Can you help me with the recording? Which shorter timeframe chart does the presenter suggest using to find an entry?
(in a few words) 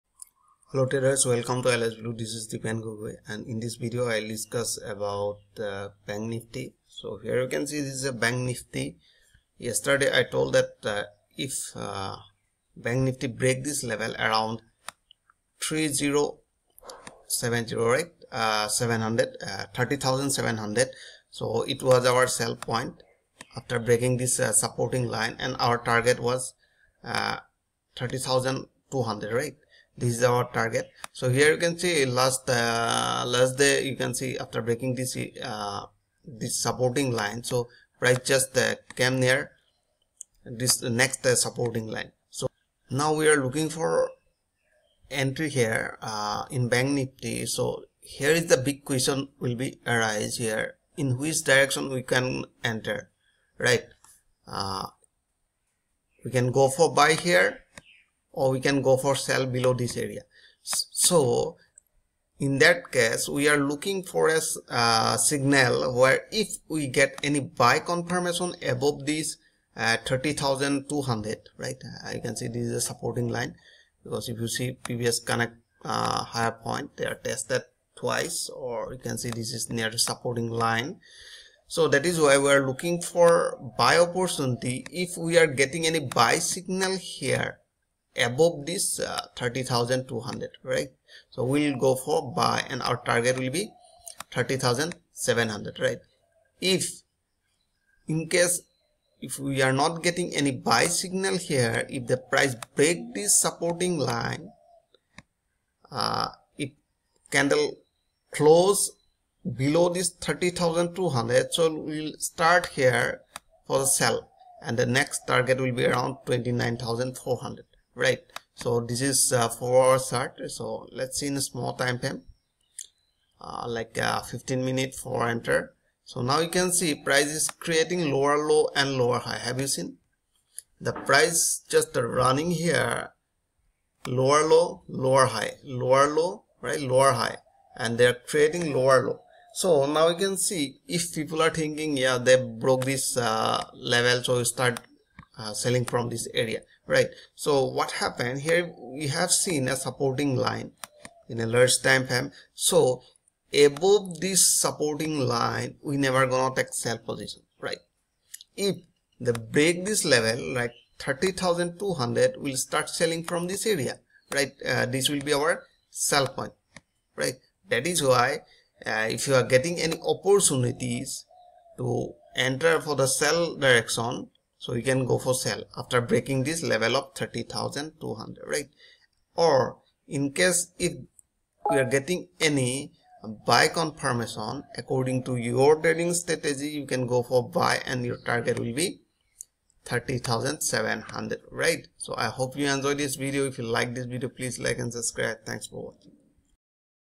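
15 minute.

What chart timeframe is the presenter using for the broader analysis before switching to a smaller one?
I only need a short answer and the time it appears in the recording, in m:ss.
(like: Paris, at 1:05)
4 hours, at 1:59.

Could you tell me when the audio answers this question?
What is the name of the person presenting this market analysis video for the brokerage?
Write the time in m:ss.
0:02.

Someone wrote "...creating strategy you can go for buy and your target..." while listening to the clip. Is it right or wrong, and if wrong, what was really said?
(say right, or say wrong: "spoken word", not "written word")
wrong: "trading", not "creating".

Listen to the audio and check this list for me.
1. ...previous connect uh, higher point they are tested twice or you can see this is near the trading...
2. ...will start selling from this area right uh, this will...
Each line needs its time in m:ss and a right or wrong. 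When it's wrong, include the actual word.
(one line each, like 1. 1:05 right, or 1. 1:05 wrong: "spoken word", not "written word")
1. 1:14 wrong: "supporting", not "trading"
2. 2:42 right.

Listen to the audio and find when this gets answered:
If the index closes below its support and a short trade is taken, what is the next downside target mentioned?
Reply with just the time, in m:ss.
1:56.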